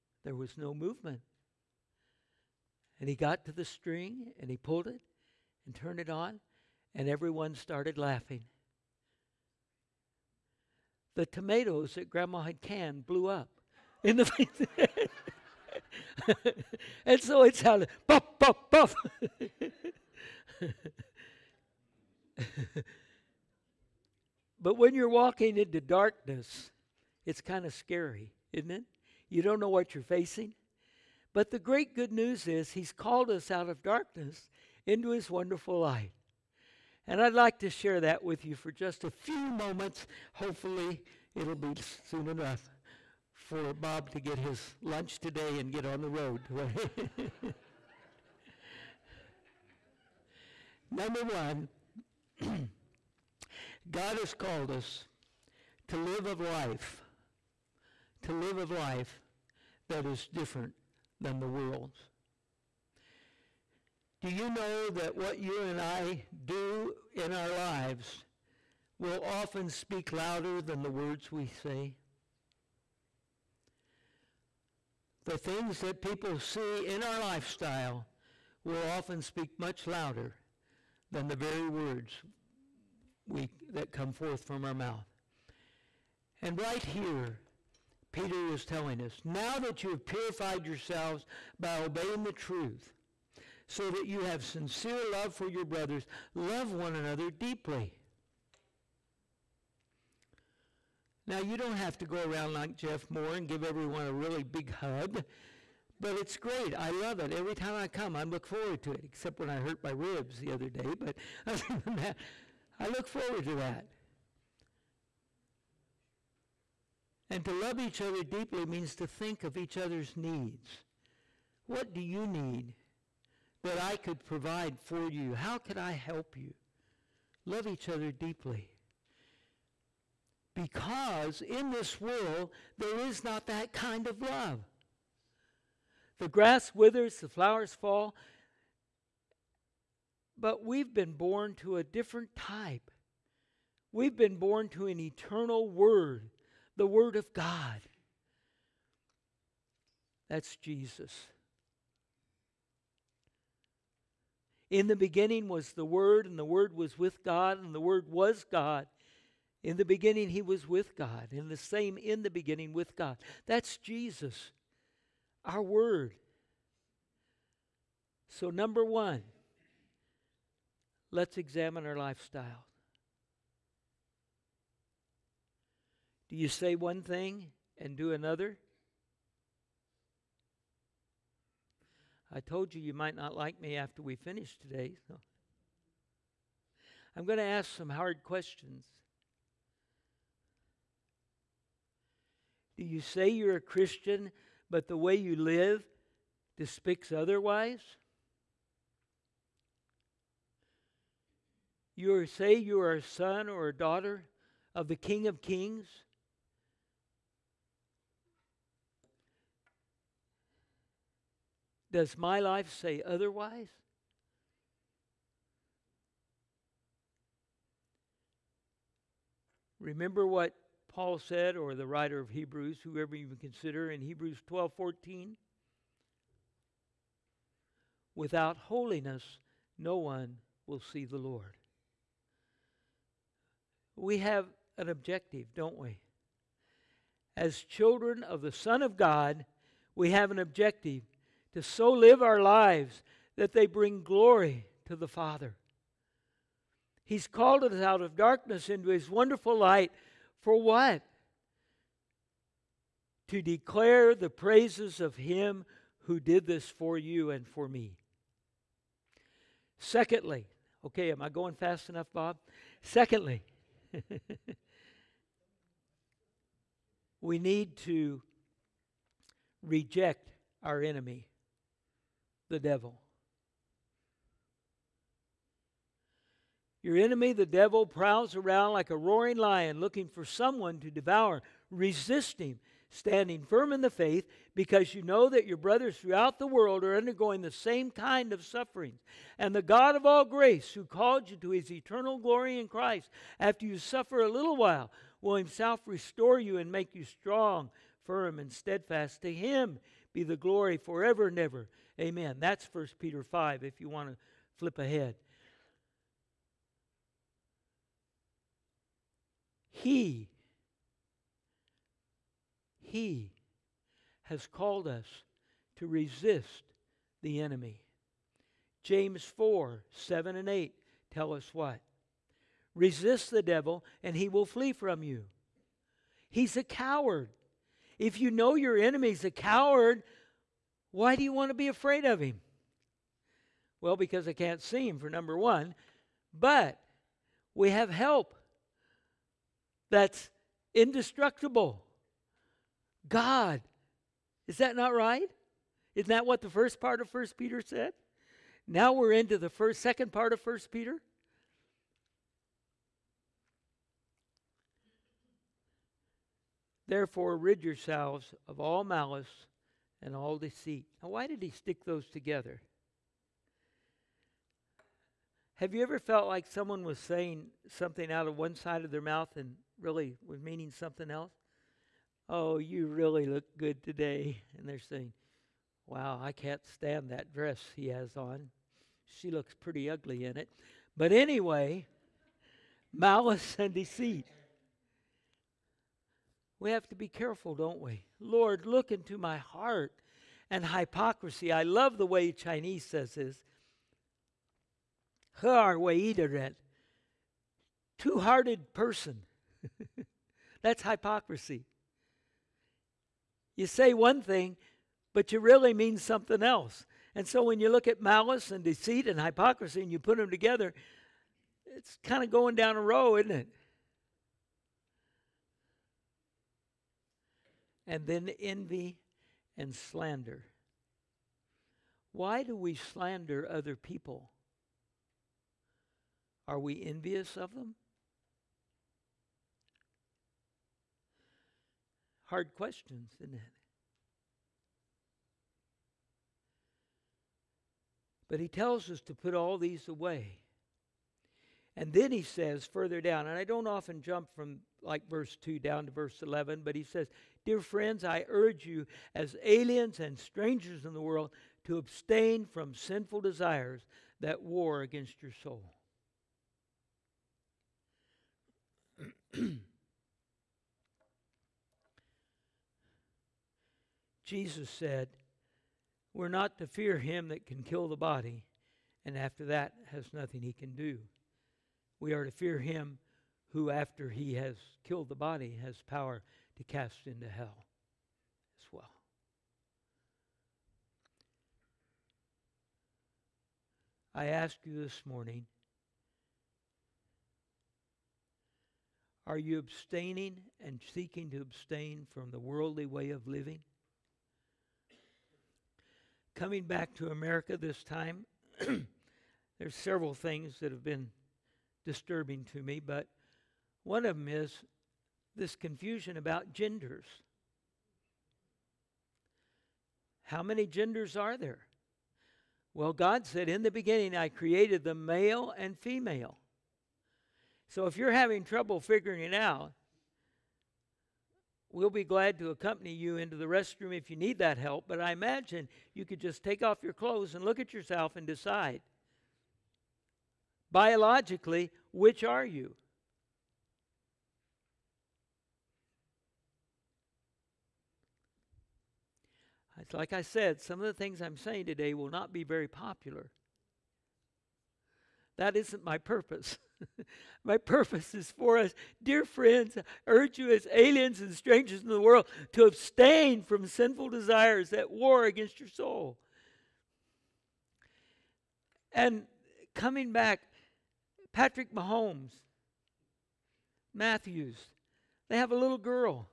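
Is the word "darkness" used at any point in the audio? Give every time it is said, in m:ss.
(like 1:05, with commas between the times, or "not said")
0:25, 0:33, 4:08.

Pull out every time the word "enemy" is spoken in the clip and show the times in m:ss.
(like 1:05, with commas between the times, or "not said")
4:30, 4:36, 5:17, 5:28.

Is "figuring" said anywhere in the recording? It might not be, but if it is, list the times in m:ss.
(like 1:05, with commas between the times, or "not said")
8:38.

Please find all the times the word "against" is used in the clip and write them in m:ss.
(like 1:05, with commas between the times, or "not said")
7:34, 9:15.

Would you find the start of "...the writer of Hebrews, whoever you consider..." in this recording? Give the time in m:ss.
3:41.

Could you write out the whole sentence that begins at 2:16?
The grass withers, the flowers fall, but we've been born to a different type.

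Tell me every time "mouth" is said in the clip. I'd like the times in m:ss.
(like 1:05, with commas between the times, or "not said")
1:24, 6:08.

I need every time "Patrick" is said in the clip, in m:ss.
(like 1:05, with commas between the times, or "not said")
9:21.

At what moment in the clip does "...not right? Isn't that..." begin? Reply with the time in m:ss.
5:44.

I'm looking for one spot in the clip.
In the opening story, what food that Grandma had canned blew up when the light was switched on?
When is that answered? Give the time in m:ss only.
0:11.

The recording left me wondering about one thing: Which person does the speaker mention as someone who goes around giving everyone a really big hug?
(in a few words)
Jeff Moore.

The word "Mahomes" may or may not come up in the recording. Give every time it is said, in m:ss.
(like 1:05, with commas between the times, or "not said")
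9:21.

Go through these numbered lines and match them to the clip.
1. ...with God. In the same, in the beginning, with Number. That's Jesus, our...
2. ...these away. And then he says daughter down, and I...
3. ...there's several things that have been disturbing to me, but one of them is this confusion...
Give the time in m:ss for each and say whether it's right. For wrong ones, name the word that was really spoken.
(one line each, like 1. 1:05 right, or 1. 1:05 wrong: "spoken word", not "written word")
1. 2:40 wrong: "God", not "Number"
2. 7:19 wrong: "further", not "daughter"
3. 8:19 right.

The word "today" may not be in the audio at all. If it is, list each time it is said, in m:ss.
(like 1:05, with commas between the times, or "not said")
0:45, 3:04, 6:13, 9:01.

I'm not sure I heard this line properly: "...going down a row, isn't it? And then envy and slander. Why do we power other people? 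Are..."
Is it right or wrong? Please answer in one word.
wrong.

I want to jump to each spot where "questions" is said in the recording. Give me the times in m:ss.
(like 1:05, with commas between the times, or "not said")
3:08, 7:12.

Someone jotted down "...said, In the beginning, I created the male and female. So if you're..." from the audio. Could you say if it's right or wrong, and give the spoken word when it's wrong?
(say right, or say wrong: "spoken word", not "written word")
right.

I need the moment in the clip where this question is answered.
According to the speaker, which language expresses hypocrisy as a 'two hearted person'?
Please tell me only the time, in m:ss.
6:32.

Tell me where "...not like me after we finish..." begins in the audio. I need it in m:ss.
3:03.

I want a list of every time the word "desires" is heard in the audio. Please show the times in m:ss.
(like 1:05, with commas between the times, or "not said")
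7:33, 9:14.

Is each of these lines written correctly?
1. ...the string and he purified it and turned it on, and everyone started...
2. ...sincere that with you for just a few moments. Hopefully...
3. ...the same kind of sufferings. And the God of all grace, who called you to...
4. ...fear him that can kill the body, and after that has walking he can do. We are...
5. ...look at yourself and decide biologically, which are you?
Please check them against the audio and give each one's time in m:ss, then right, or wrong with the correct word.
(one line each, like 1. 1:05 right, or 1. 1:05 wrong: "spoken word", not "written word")
1. 0:03 wrong: "pulled", not "purified"
2. 0:37 wrong: "share", not "sincere"
3. 4:47 right
4. 7:46 wrong: "nothing", not "walking"
5. 8:47 right.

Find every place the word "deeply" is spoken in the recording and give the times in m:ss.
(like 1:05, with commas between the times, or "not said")
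1:37, 1:58, 2:08.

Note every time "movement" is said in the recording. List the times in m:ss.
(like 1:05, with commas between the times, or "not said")
0:00.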